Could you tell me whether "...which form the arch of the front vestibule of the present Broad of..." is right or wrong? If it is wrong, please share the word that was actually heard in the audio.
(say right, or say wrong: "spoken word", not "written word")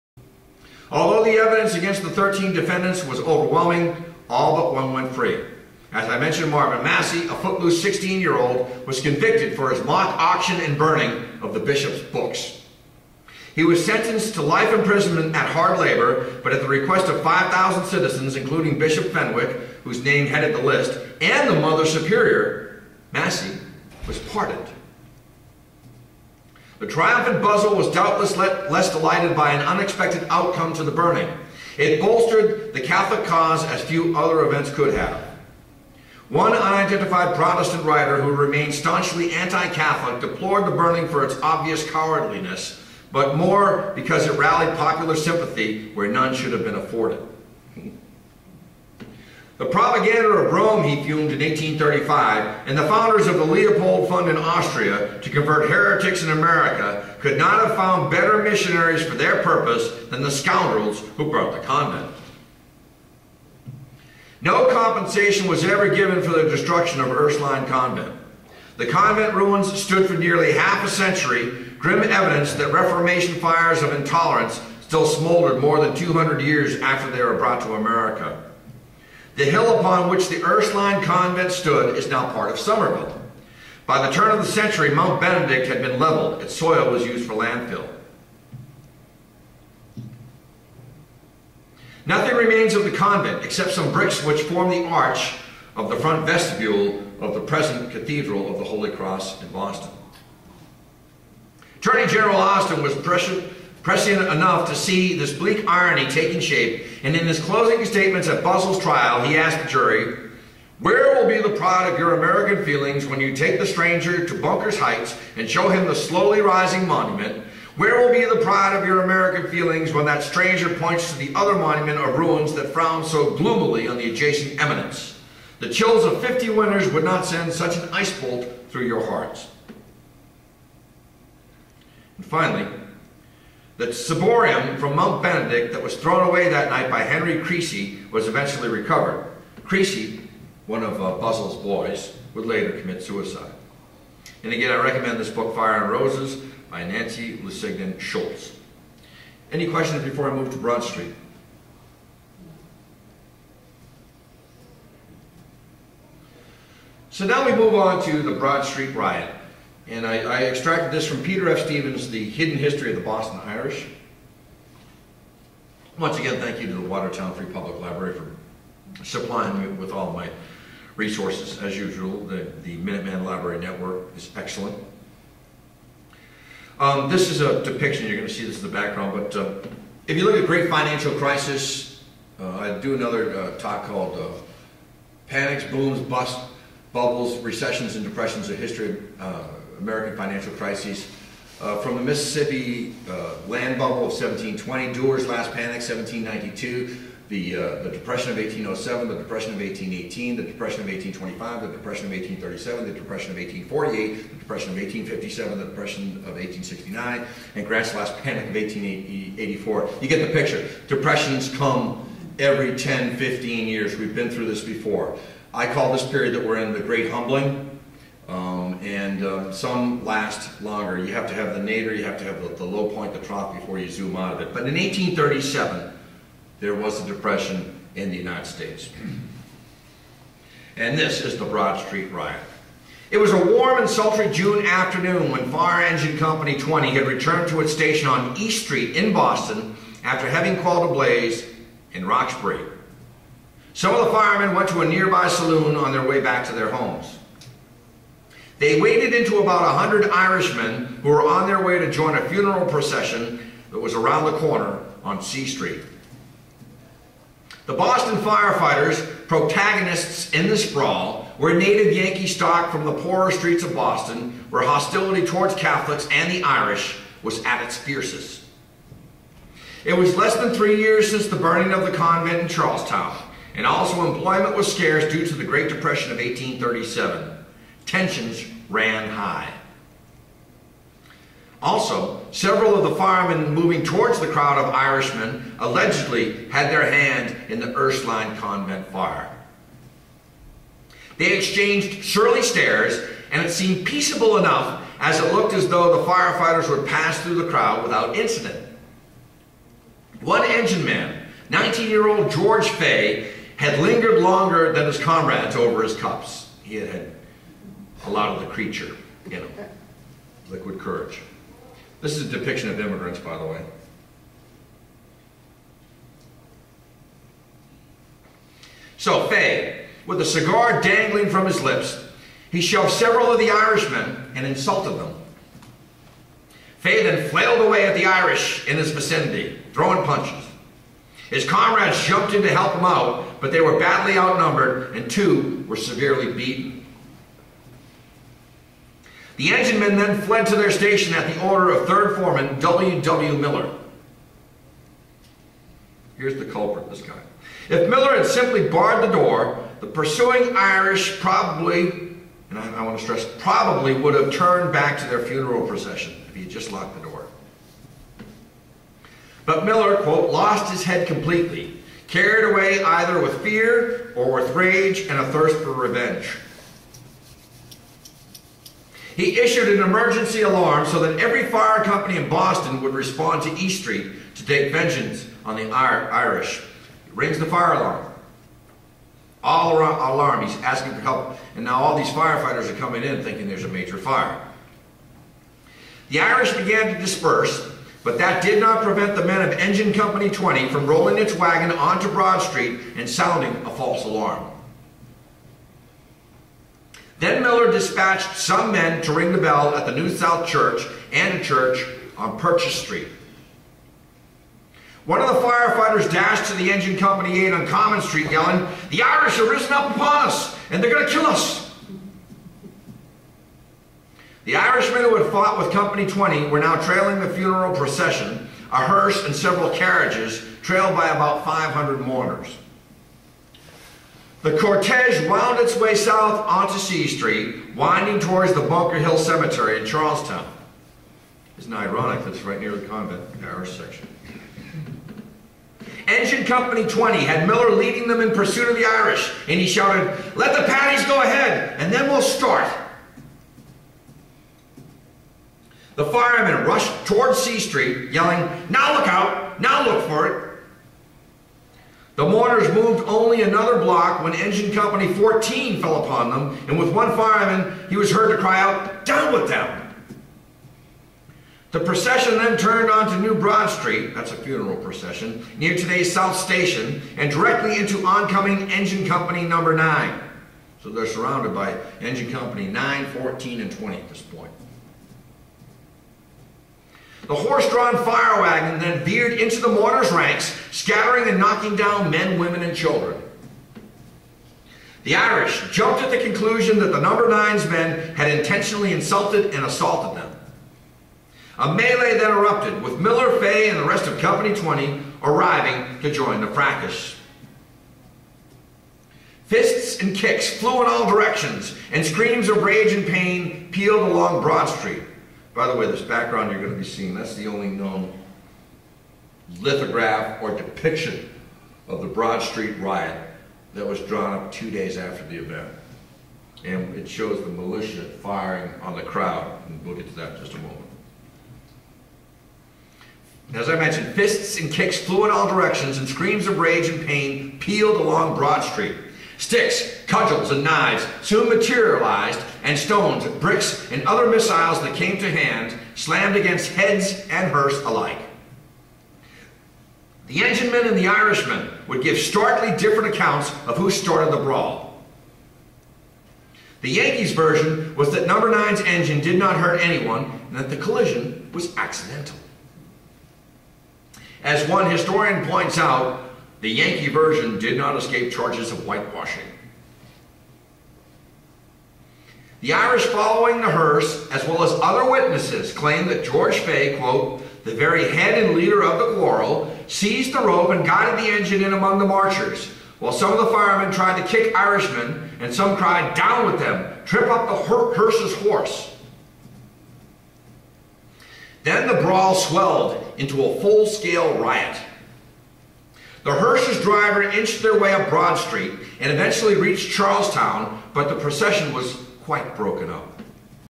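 wrong: "Cathedral", not "Broad".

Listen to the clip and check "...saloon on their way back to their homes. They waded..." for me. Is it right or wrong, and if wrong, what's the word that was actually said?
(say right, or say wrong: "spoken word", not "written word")
right.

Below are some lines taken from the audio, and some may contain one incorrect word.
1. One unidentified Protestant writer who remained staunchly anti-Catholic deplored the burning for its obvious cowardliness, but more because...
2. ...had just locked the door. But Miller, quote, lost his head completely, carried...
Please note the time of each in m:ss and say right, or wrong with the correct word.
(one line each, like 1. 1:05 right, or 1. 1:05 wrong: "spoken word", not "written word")
1. 0:36 right
2. 5:56 right.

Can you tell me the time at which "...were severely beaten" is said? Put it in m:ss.
5:35.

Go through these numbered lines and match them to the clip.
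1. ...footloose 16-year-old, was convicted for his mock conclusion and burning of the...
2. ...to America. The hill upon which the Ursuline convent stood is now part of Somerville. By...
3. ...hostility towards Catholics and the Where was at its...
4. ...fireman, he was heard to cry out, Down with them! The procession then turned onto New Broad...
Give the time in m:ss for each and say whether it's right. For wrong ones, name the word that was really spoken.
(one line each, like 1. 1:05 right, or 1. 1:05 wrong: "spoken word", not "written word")
1. 0:07 wrong: "auction", not "conclusion"
2. 1:17 right
3. 4:24 wrong: "Irish", not "Where"
4. 7:37 right.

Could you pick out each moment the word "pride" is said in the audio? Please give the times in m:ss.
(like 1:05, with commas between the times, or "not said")
1:51, 1:58.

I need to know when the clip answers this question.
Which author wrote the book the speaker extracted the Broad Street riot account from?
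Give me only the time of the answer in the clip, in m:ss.
2:41.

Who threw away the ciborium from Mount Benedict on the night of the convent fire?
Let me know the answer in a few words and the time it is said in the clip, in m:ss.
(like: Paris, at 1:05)
Henry Creasy, at 2:17.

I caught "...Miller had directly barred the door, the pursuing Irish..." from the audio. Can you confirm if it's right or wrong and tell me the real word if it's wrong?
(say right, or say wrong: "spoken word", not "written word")
wrong: "simply", not "directly".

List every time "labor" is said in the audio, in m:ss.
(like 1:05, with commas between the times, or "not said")
0:15.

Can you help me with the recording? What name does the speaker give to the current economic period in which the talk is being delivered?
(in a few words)
the Great Humbling.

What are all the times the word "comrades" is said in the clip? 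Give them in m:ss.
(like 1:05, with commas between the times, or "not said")
5:04, 5:31.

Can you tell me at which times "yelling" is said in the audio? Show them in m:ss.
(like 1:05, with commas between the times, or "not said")
6:48, 7:28.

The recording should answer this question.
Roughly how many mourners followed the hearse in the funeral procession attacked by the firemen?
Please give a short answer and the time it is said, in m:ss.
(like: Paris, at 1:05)
500, at 7:01.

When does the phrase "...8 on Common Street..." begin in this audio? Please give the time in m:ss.
6:47.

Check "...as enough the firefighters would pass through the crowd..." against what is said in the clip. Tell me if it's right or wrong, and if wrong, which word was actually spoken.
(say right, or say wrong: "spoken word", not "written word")
wrong: "though", not "enough".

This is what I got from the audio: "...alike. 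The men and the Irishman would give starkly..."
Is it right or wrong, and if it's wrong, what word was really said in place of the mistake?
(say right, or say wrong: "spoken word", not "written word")
right.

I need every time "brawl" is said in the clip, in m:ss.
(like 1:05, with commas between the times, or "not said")
9:04, 9:42.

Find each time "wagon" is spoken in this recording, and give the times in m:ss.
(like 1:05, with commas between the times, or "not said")
6:31, 7:58.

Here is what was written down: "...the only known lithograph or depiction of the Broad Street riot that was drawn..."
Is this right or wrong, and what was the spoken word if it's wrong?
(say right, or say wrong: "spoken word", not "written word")
right.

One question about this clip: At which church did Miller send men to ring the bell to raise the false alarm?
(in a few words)
New South Church.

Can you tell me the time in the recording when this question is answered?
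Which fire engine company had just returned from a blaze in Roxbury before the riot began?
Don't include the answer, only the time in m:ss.
3:55.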